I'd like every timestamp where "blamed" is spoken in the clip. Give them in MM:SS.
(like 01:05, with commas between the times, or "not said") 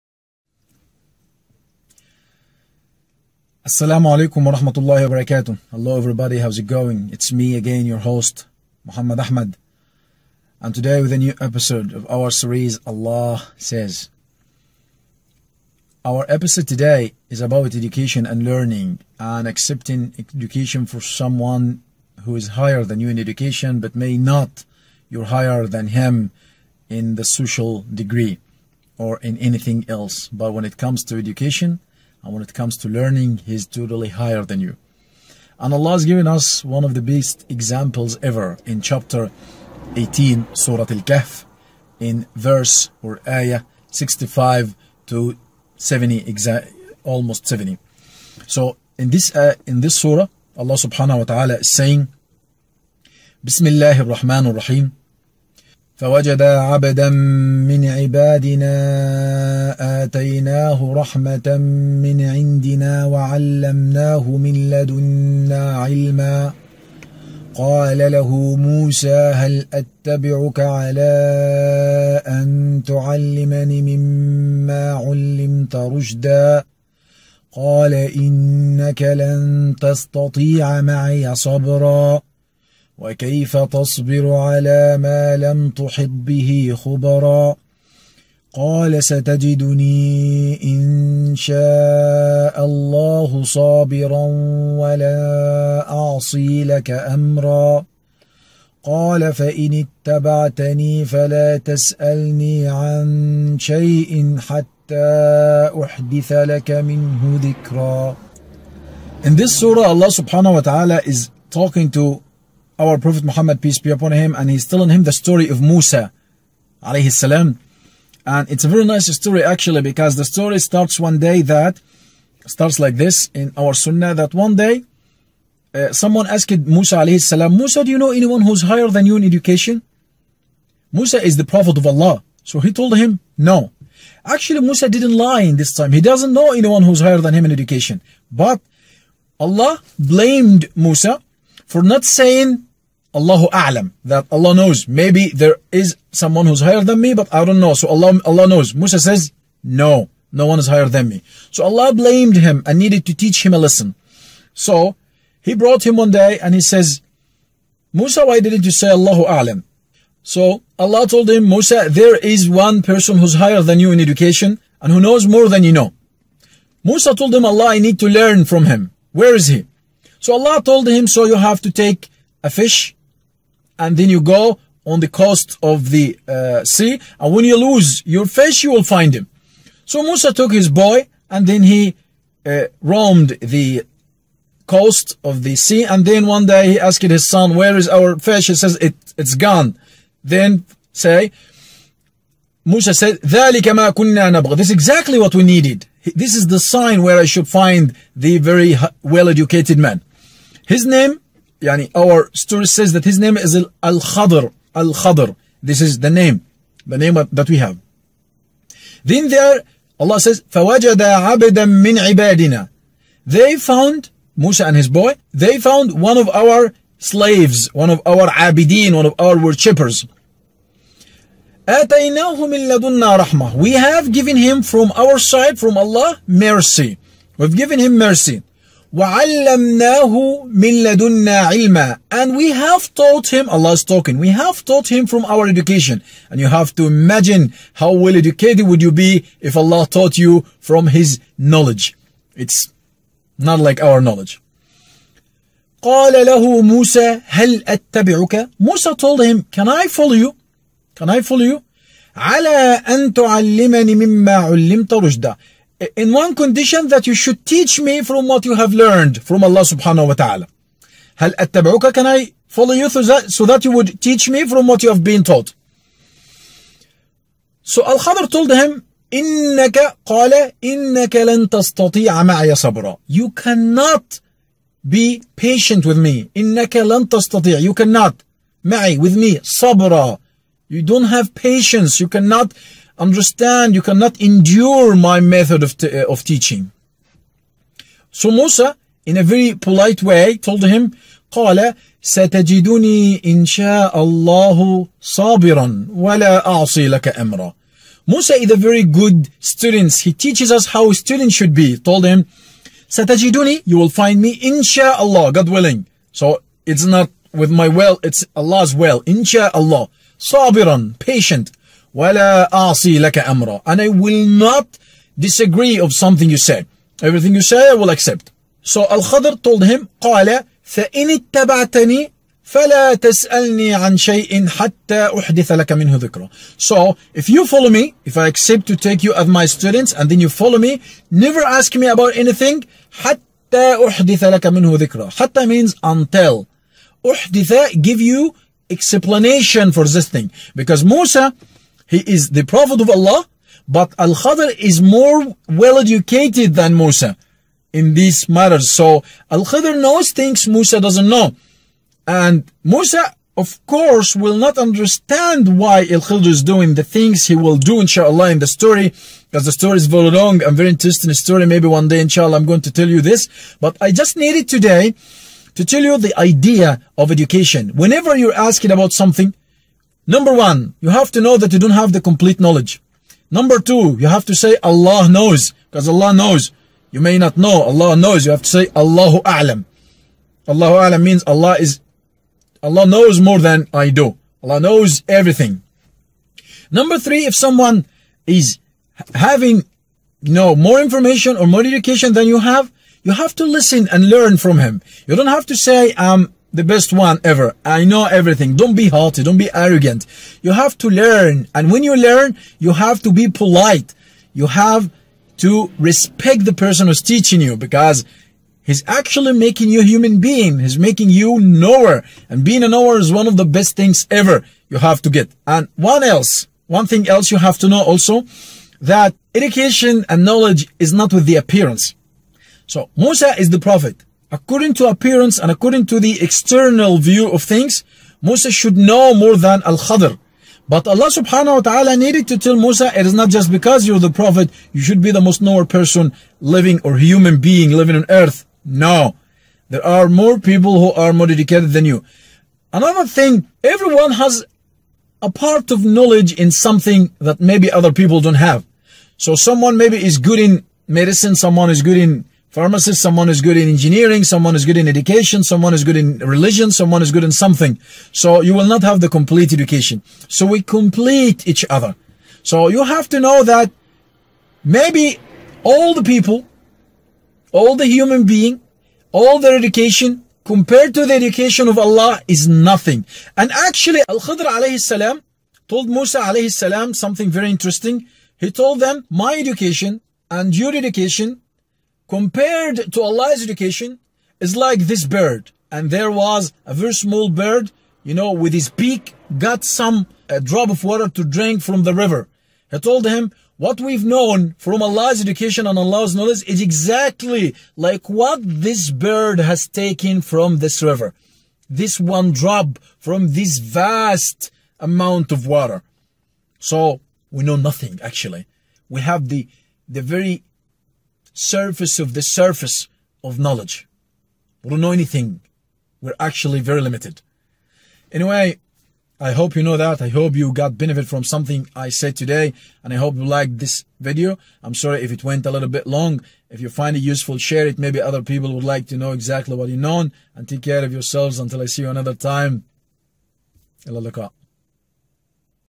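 02:19, 02:31.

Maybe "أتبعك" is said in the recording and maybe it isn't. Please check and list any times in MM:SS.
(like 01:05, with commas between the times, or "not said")
01:09, 04:07.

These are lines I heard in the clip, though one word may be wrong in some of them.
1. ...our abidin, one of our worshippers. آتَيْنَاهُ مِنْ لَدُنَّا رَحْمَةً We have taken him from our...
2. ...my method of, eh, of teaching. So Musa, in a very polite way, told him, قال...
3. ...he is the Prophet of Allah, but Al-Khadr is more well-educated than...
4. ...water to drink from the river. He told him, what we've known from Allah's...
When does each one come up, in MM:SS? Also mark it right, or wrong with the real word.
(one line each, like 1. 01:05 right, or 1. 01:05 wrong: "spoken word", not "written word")
1. 03:38 wrong: "given", not "taken"
2. 04:44 right
3. 05:41 right
4. 08:10 right.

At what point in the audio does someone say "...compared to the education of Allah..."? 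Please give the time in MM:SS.
07:50.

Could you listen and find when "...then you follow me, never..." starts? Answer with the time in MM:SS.
05:30.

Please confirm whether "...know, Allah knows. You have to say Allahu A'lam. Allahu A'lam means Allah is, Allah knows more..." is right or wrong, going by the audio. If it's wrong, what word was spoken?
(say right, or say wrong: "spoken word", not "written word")
right.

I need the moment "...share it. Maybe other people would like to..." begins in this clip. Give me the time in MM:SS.
08:47.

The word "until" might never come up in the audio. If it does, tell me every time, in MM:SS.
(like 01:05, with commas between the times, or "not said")
05:35, 08:51.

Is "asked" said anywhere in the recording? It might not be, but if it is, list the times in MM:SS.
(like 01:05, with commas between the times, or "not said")
02:06, 03:06.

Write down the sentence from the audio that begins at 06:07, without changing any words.
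Whenever you're asking about something, Number one, you have to know that you don't have the complete knowledge.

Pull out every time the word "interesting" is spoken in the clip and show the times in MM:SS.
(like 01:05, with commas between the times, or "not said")
06:00, 07:57.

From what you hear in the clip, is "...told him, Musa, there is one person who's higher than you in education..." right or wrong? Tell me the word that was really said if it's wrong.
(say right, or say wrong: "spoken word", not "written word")
right.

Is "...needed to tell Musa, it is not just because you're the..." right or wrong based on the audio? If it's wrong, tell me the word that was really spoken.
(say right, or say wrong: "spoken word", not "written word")
right.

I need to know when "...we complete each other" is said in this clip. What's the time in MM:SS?
07:40.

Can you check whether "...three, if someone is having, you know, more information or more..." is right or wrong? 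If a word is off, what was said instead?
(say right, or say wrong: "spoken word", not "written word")
right.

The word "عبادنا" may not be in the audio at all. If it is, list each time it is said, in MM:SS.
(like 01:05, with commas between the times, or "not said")
00:57, 03:32.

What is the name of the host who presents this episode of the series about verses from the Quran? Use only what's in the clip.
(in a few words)
Muhammad Ahmad.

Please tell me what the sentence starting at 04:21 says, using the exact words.
هل اتبعوك can I follow you through that so that you would teach me from what you have been taught.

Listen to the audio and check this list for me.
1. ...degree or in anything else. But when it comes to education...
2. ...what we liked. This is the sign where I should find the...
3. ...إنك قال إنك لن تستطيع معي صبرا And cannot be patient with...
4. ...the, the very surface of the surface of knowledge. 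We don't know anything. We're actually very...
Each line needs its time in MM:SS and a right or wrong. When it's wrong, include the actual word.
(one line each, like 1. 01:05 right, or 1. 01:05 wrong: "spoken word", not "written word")
1. 00:27 right
2. 03:15 wrong: "needed", not "liked"
3. 04:29 wrong: "You", not "And"
4. 08:29 right.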